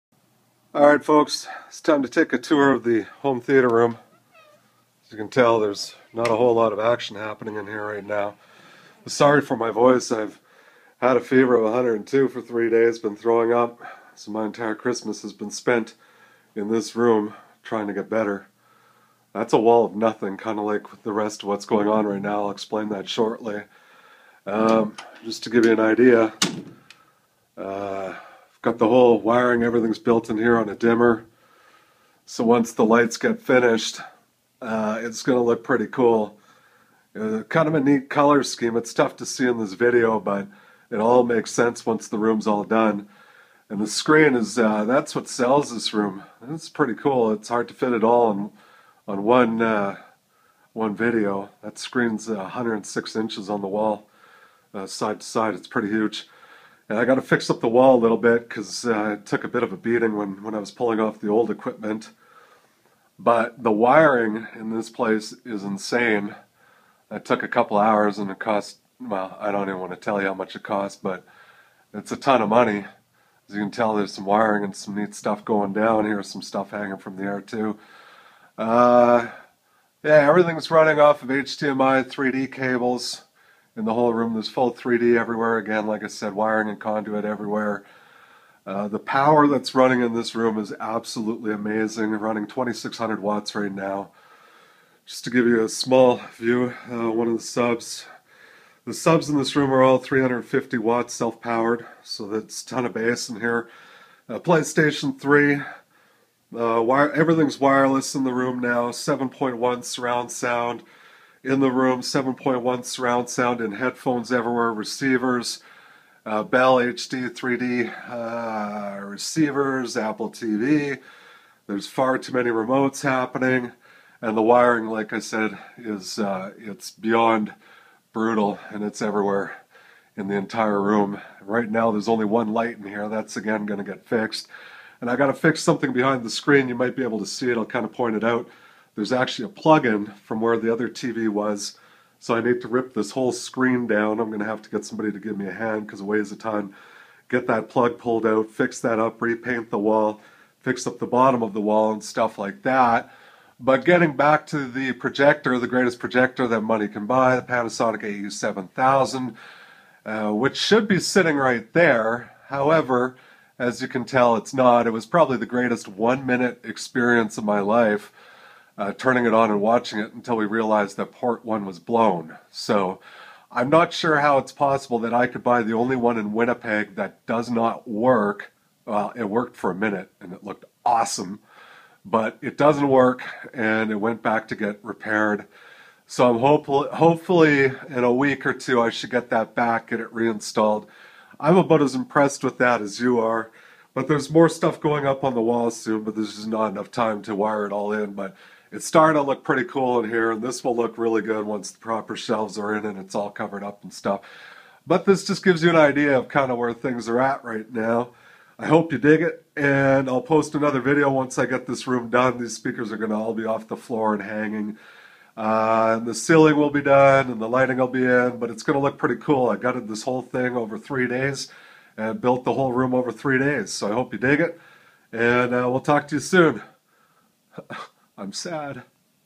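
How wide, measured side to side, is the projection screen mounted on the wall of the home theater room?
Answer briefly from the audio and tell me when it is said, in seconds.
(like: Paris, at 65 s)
106 inches, at 52 s.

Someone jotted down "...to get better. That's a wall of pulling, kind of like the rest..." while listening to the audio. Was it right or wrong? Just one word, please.
wrong.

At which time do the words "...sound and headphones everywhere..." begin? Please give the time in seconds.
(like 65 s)
113 s.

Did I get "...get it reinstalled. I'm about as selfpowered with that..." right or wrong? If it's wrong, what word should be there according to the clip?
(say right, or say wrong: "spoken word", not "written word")
wrong: "impressed", not "selfpowered".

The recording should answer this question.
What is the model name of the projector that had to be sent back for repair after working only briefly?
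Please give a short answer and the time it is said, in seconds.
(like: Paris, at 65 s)
Panasonic AE7000, at 157 s.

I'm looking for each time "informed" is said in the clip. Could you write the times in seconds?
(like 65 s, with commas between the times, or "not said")
not said.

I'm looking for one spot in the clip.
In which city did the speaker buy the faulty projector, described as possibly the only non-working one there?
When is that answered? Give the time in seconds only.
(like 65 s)
176 s.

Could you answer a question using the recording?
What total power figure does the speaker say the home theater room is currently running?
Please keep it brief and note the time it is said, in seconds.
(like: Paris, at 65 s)
2600 watts, at 92 s.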